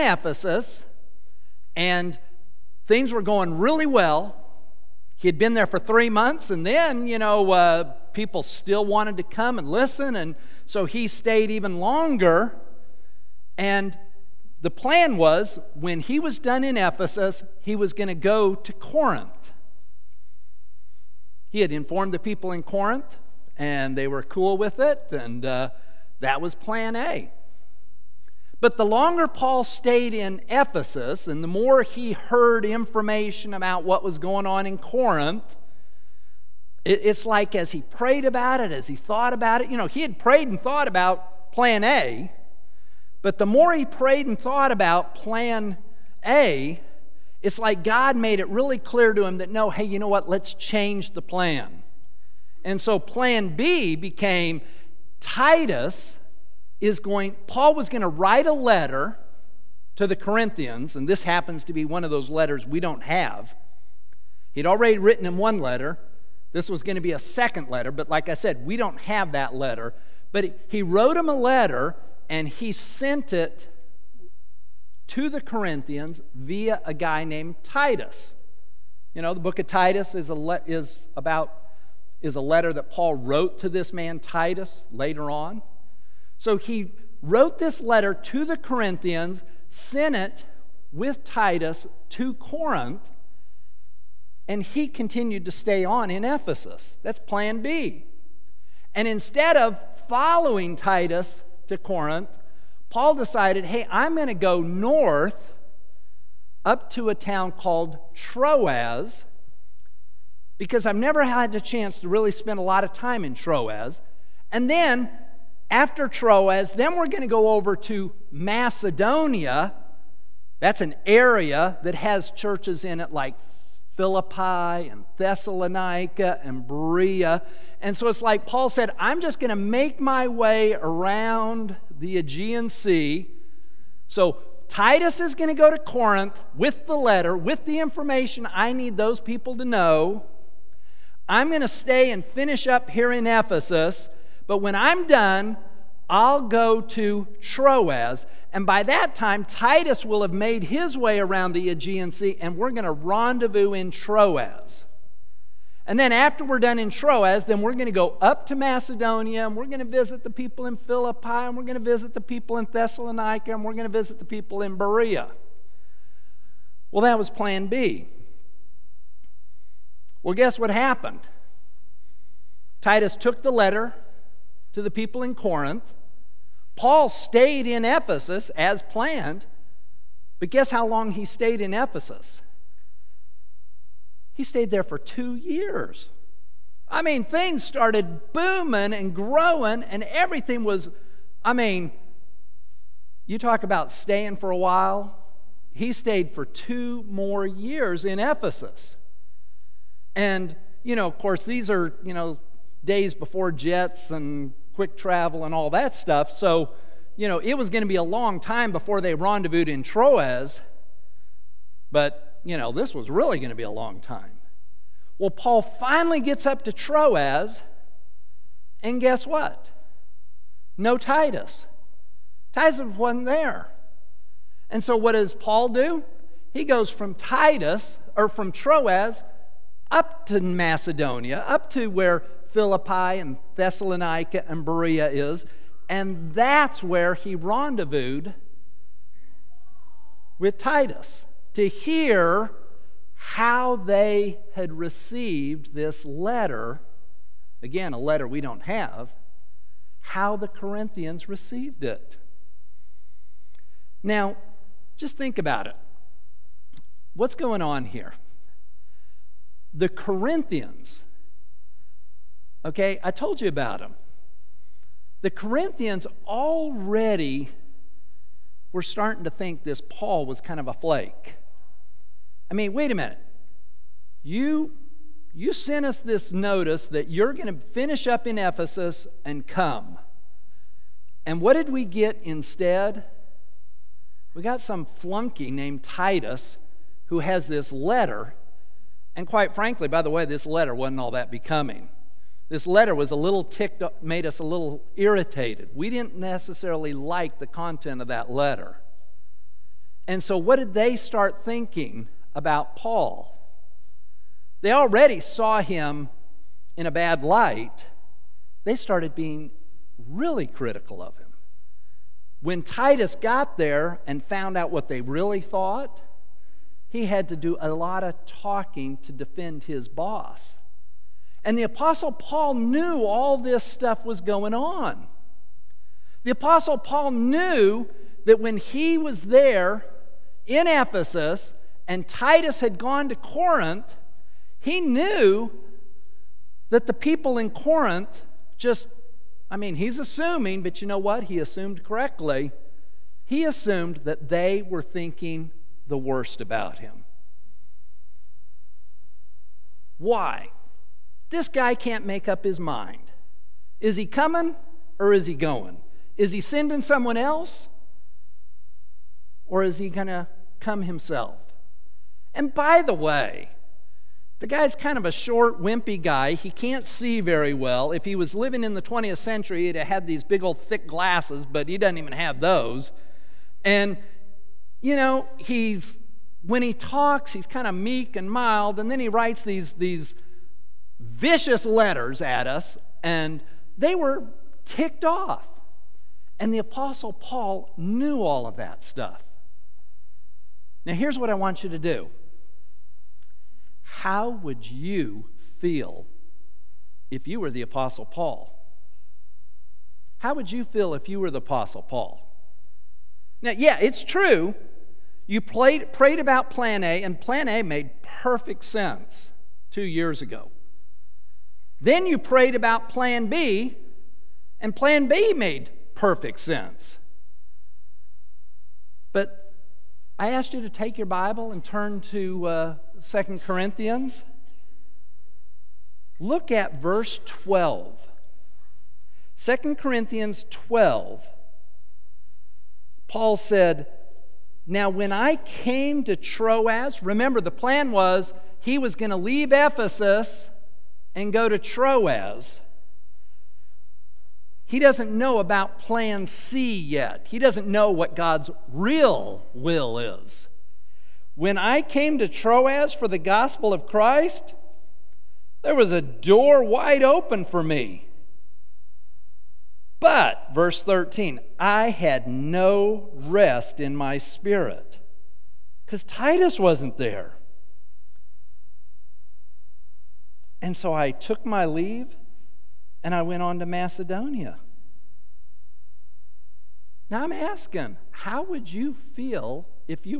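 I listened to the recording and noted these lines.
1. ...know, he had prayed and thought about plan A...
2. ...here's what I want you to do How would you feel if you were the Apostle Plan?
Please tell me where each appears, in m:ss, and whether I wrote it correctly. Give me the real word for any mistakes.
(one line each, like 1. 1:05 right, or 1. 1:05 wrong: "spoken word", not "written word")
1. 0:39 right
2. 6:30 wrong: "Paul", not "Plan".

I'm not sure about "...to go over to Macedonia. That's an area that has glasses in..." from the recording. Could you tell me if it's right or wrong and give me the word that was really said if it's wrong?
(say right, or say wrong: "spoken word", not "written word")
wrong: "churches", not "glasses".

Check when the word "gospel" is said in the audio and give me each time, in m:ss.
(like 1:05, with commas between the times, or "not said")
7:33.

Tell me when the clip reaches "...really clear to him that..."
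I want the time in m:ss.
0:48.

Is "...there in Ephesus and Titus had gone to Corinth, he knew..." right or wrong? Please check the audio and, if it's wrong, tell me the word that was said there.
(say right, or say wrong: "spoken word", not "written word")
right.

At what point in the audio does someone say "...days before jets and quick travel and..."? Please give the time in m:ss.
3:22.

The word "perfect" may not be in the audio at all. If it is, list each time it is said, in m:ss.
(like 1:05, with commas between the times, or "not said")
6:48, 6:55.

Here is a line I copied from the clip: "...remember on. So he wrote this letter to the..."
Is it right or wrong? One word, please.
wrong.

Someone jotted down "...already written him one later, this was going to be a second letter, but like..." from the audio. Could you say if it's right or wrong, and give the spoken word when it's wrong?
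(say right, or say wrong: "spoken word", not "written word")
wrong: "letter", not "later".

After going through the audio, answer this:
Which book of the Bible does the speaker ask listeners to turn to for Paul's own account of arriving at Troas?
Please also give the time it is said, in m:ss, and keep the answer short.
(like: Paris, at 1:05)
Second Corinthians, at 7:02.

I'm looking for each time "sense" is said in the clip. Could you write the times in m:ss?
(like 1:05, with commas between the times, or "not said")
6:48, 6:56.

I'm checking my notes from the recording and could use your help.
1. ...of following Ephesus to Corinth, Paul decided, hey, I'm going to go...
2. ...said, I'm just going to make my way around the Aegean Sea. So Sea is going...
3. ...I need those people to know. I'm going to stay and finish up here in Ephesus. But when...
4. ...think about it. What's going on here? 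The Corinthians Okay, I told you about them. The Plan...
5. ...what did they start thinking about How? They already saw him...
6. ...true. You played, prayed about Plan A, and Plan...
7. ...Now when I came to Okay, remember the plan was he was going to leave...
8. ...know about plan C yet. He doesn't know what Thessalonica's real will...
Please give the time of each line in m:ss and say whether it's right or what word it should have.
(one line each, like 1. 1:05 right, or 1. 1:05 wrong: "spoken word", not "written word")
1. 1:39 wrong: "Titus", not "Ephesus"
2. 2:08 wrong: "Titus", not "Sea"
3. 2:18 right
4. 4:15 wrong: "Corinthians", not "Plan"
5. 5:00 wrong: "Paul", not "How"
6. 6:44 right
7. 7:14 wrong: "Troas", not "Okay"
8. 7:25 wrong: "God", not "Thessalonica".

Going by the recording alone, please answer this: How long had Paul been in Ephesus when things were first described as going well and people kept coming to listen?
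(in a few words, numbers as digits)
3 months.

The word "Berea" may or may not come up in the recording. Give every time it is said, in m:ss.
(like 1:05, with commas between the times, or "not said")
2:06, 2:44, 3:54.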